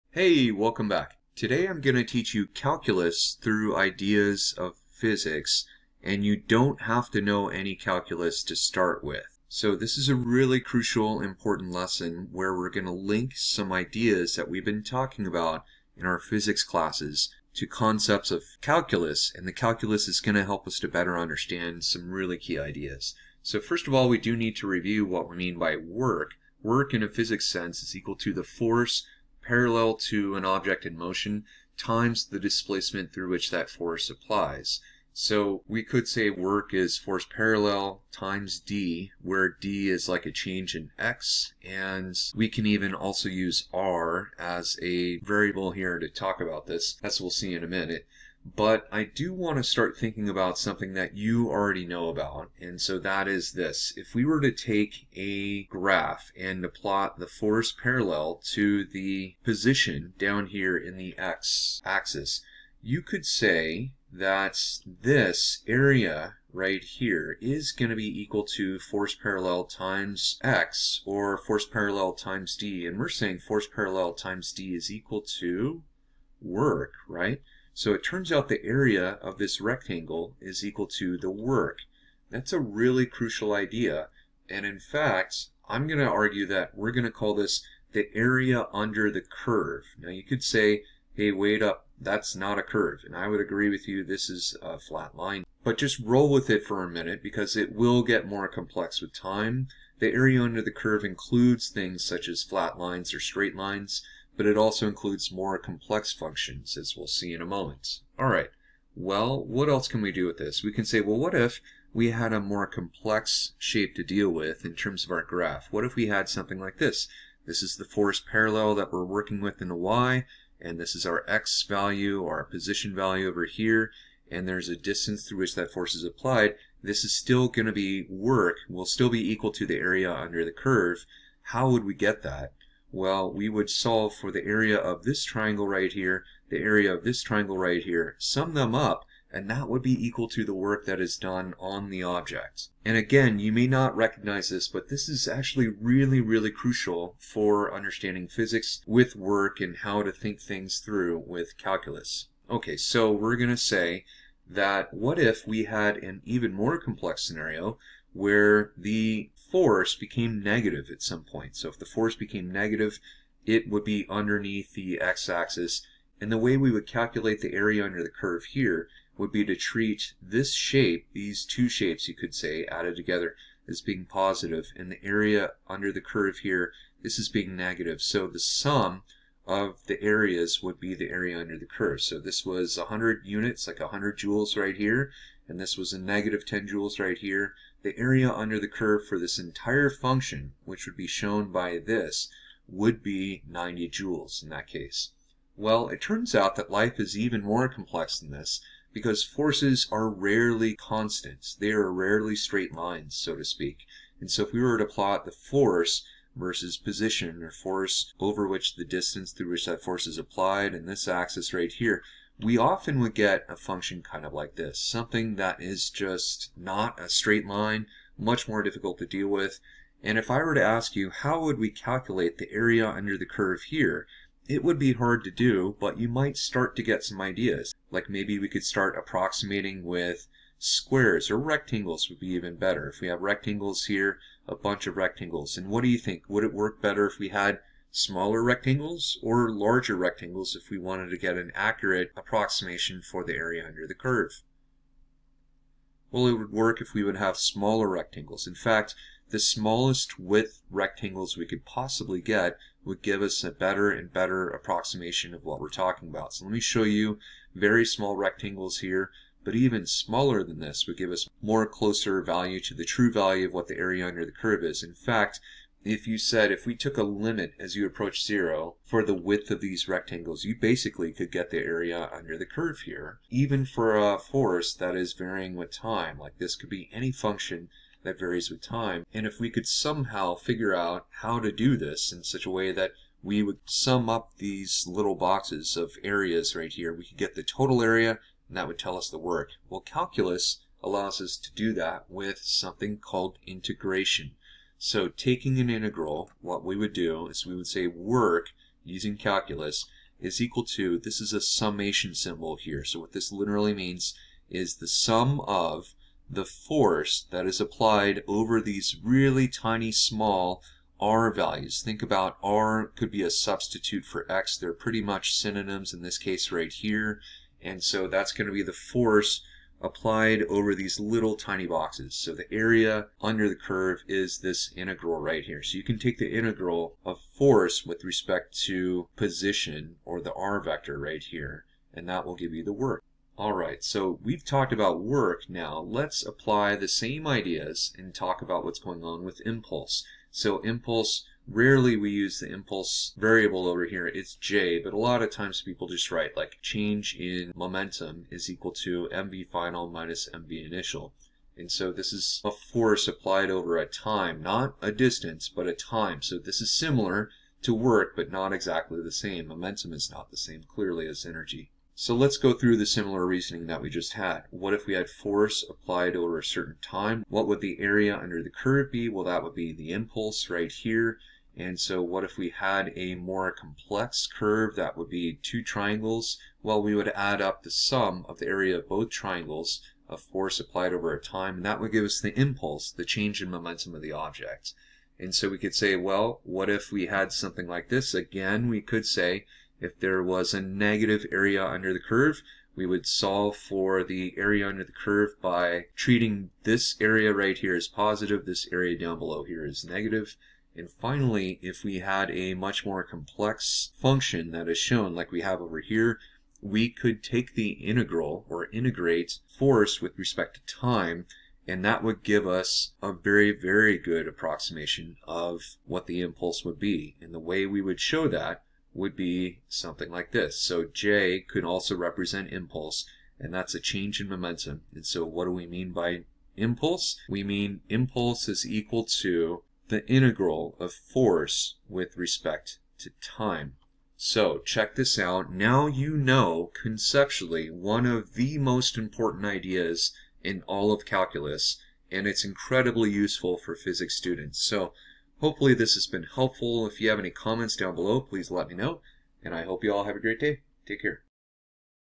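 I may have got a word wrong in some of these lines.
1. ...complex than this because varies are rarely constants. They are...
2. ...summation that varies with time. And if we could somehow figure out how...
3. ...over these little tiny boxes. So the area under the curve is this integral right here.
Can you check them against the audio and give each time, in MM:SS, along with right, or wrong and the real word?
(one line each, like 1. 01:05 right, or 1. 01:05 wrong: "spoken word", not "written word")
1. 03:17 wrong: "forces", not "varies"
2. 04:37 wrong: "function", not "summation"
3. 05:20 right.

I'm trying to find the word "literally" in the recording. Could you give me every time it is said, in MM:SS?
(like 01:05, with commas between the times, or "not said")
05:03.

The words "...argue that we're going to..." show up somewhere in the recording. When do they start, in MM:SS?
01:26.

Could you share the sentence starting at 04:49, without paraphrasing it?
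Well, calculus allows us to do that with something called integration.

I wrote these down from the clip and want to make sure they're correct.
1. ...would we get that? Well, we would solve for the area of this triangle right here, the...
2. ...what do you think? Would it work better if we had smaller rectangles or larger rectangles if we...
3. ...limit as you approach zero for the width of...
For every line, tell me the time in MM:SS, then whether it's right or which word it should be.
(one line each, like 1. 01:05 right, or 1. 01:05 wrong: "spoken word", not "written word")
1. 02:11 right
2. 03:55 right
3. 04:27 right.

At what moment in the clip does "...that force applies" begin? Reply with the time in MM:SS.
00:33.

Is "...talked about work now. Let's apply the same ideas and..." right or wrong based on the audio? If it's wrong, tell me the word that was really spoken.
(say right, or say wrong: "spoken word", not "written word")
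right.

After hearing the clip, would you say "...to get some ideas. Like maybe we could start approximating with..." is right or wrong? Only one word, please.
right.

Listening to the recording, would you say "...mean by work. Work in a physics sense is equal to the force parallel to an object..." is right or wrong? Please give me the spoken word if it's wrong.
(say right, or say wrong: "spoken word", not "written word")
right.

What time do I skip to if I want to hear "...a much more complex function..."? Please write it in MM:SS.
06:42.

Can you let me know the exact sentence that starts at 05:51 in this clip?
And so this is a force applied over a time, not a distance, but a time.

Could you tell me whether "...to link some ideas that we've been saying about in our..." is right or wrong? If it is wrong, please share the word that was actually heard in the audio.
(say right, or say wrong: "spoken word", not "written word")
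wrong: "talking", not "saying".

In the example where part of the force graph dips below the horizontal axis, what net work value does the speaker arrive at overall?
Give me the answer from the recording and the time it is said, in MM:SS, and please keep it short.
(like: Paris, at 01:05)
90 joules, at 03:13.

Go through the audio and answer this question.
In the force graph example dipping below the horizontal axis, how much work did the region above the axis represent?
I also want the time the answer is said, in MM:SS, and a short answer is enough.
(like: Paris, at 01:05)
100 joules, at 03:03.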